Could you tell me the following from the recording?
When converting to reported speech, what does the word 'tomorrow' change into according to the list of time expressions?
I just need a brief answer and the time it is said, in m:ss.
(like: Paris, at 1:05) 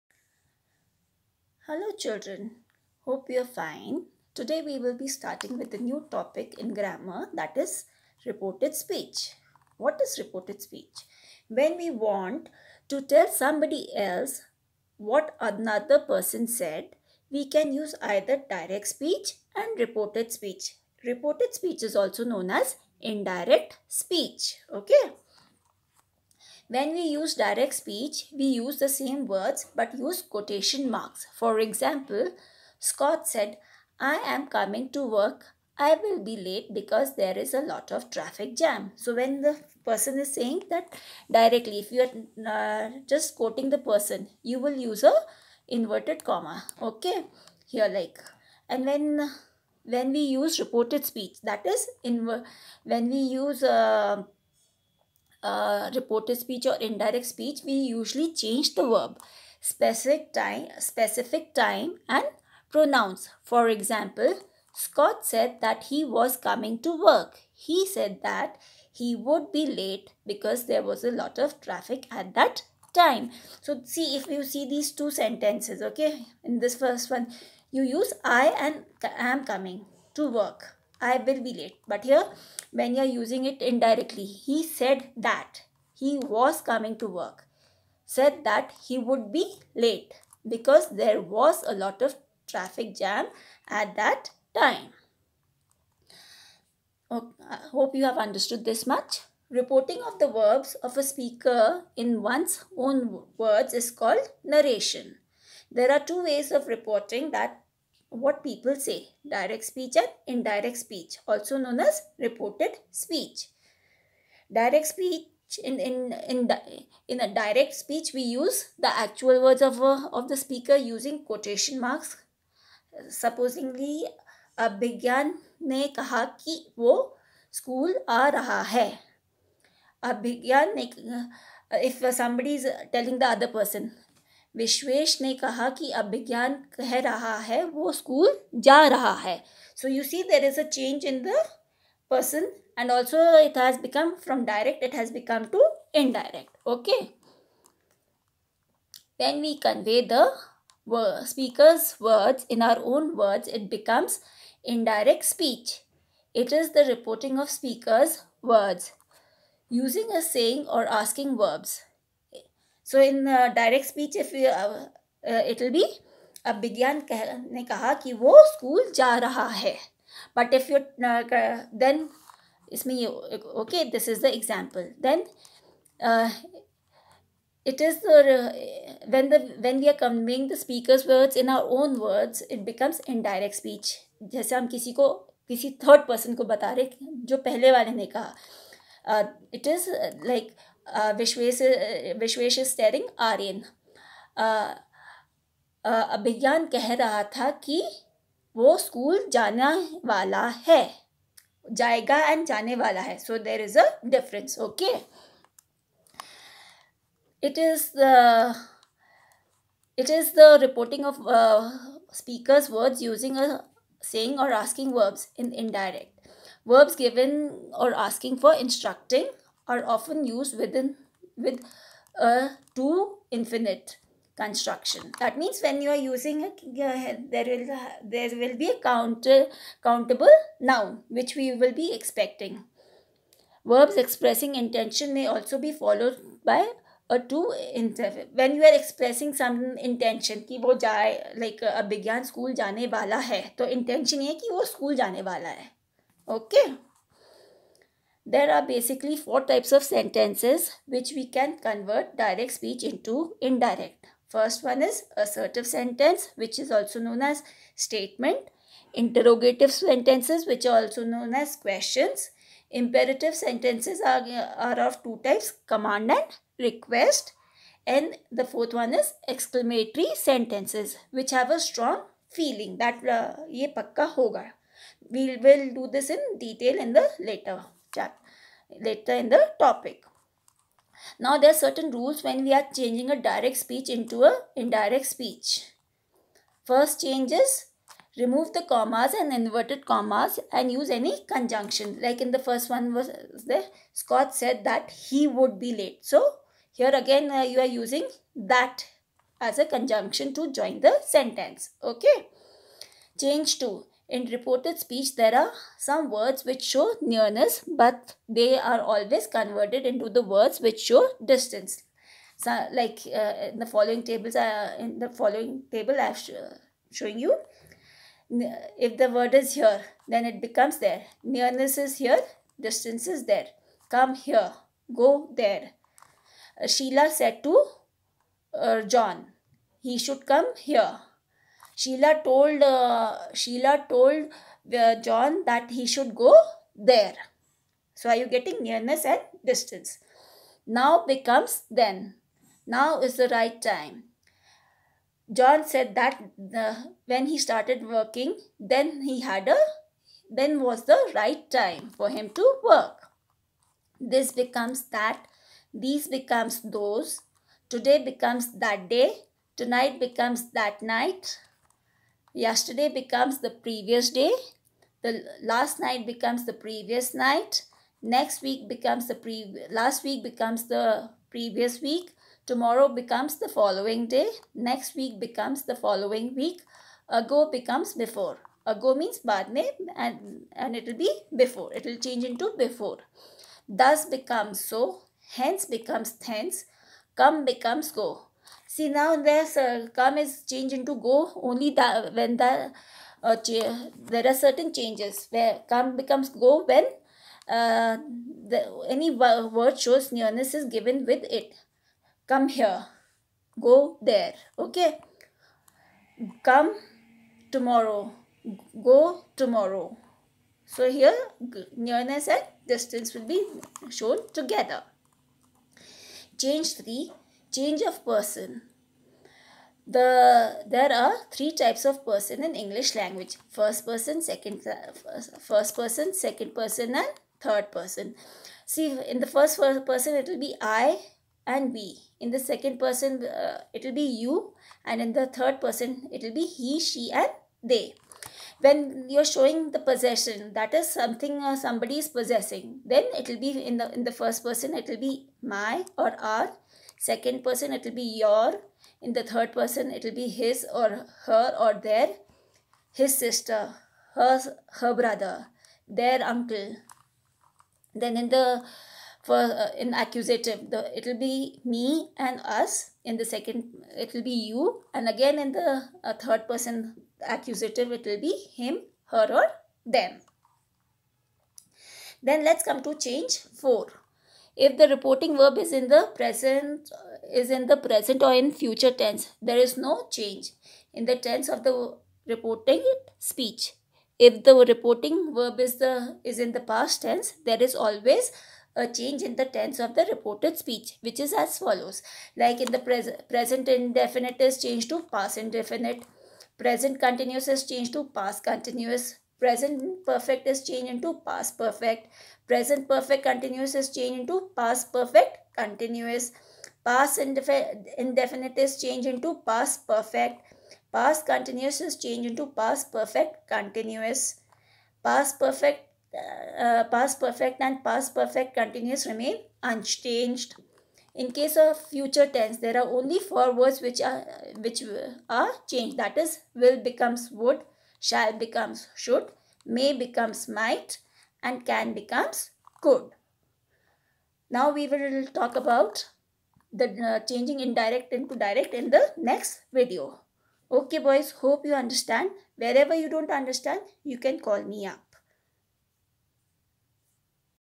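the following day, at 6:12.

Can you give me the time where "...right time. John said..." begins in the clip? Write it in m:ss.
5:43.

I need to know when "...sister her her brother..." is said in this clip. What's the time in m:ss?
7:33.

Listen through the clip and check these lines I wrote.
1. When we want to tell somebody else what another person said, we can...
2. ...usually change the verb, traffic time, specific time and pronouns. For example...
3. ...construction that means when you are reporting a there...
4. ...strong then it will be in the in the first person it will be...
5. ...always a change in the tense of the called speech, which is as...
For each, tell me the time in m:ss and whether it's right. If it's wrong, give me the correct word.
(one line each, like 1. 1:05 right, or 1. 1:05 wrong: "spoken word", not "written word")
1. 0:11 right
2. 0:57 wrong: "specific", not "traffic"
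3. 3:44 wrong: "using", not "reporting"
4. 7:22 wrong: "possessing", not "strong"
5. 8:07 wrong: "reported", not "called".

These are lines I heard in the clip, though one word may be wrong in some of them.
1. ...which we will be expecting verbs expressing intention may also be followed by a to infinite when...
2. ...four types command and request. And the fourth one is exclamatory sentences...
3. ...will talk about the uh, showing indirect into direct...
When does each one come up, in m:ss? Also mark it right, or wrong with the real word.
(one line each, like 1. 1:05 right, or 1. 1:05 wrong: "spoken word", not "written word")
1. 3:51 right
2. 4:25 wrong: "two", not "four"
3. 8:54 wrong: "changing", not "showing".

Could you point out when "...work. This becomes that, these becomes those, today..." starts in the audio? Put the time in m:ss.
5:52.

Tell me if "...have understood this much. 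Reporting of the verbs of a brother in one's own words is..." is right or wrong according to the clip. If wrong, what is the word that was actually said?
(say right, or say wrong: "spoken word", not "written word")
wrong: "speaker", not "brother".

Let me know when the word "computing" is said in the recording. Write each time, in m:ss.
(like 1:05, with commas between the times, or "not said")
not said.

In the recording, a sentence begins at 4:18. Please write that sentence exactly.
Interrogative sentences which are also known as questions.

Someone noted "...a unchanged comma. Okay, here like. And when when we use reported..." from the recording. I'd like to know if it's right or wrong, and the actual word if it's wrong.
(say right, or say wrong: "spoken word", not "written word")
wrong: "inverted", not "unchanged".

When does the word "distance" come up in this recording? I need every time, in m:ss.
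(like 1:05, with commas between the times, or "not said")
5:11, 5:22, 5:39, 6:52.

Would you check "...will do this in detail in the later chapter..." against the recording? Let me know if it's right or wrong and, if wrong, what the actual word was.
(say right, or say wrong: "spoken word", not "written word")
right.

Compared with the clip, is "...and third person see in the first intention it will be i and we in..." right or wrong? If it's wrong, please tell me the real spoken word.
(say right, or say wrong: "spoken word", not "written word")
wrong: "person", not "intention".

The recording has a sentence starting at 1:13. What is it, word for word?
So see if you see these two sentences, okay?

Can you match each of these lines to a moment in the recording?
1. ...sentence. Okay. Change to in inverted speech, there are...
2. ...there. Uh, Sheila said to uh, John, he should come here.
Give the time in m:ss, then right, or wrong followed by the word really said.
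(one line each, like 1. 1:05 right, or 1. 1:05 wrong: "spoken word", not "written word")
1. 5:01 wrong: "reported", not "inverted"
2. 5:25 right.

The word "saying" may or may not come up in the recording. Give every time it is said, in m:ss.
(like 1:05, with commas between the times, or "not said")
0:40.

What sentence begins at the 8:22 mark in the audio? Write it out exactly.
Present perfect continuous is changed into past perfect continuous.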